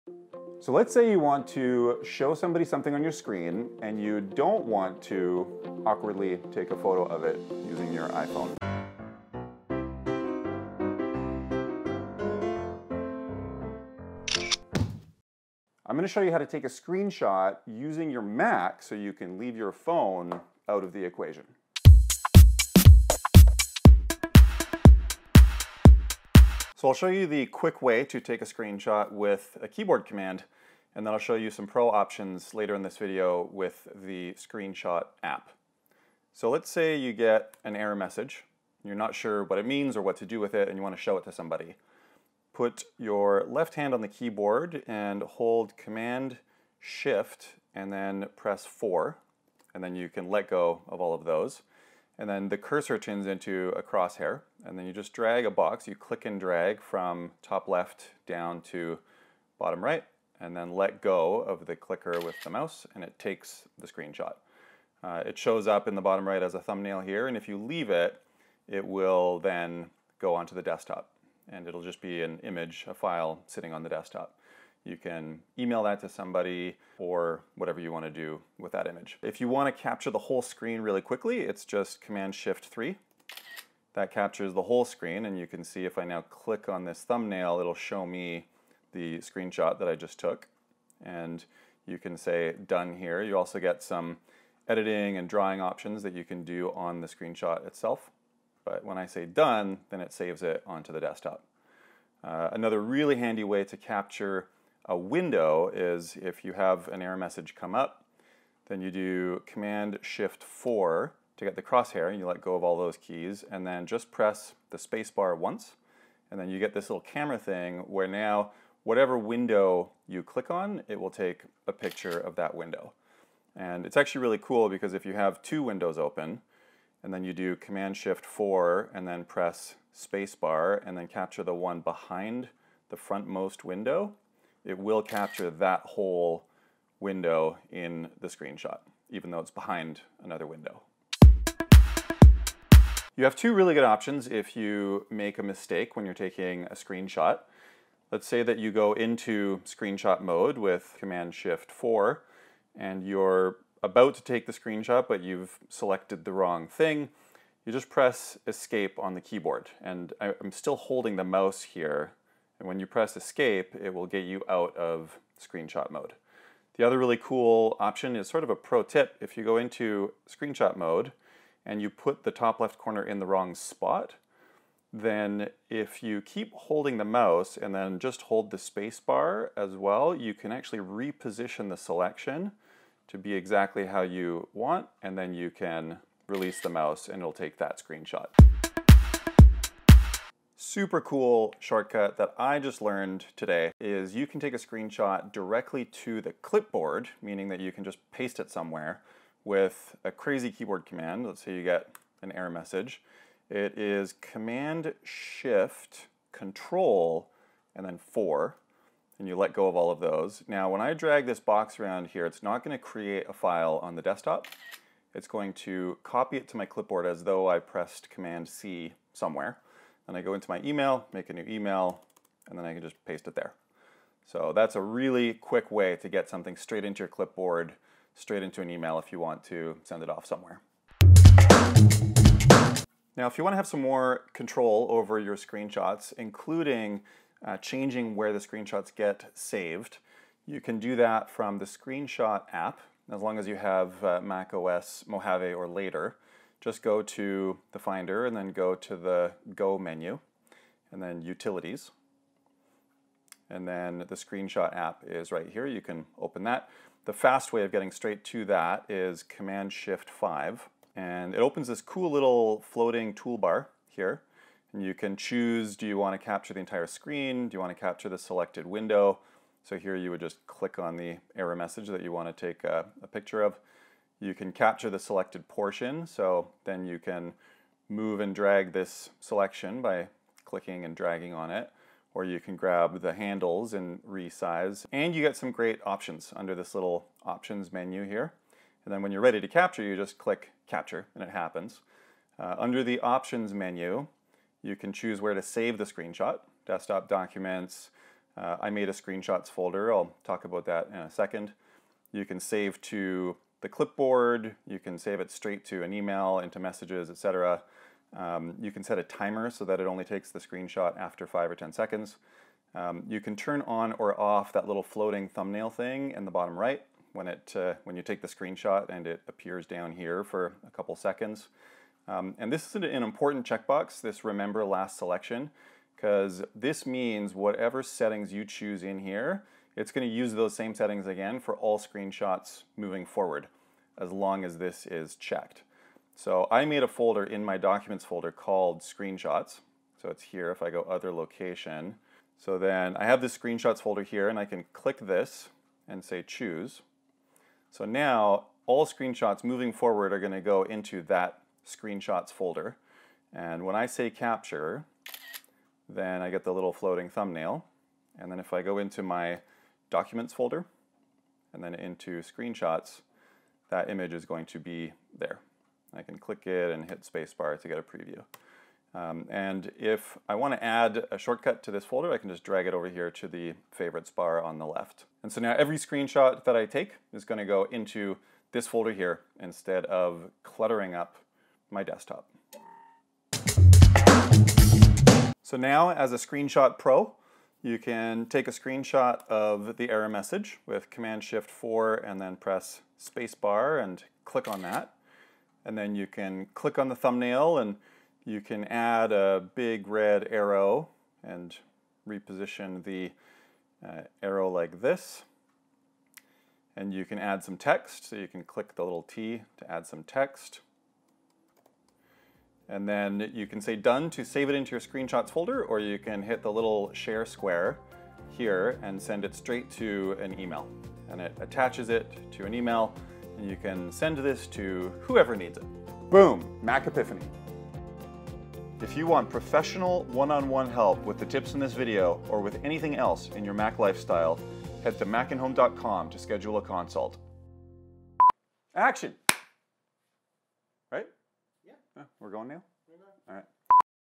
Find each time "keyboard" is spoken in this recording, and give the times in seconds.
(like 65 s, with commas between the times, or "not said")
29 s, 44 s, 159 s, 200 s.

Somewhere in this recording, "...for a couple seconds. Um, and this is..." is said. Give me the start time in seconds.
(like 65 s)
320 s.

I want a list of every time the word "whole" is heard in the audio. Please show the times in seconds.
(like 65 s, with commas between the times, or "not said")
80 s, 84 s, 135 s.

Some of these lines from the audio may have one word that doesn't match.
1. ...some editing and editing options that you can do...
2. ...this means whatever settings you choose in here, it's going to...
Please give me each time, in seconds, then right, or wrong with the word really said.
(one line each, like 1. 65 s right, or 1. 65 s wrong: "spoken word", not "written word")
1. 93 s wrong: "drawing", not "editing"
2. 326 s right.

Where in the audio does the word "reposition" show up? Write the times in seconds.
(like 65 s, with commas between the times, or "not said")
180 s, 402 s.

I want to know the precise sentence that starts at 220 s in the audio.
Then I go into my email, make a new email, and then I can just paste it there.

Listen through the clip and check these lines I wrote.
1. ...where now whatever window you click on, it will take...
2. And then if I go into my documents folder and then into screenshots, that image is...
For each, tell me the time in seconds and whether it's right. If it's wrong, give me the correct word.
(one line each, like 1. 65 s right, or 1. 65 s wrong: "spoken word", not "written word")
1. 117 s right
2. 358 s right.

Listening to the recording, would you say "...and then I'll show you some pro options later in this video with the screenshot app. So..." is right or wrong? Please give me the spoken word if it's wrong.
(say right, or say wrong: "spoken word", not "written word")
right.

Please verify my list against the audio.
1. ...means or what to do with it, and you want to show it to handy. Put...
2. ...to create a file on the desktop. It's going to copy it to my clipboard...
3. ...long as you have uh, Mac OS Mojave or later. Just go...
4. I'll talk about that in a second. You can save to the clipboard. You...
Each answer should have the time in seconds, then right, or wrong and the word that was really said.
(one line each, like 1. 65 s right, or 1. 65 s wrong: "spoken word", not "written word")
1. 39 s wrong: "somebody", not "handy"
2. 212 s right
3. 243 s right
4. 299 s right.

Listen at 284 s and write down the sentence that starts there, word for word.
And you get some great options under this little options menu here.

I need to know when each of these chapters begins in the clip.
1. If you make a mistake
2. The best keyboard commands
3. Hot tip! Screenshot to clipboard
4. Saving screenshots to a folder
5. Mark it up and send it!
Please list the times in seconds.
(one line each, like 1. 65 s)
1. 142 s
2. 23 s
3. 188 s
4. 230 s
5. 384 s.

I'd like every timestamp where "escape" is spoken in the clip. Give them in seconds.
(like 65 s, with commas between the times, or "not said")
158 s, 163 s.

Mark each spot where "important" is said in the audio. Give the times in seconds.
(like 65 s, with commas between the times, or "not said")
323 s.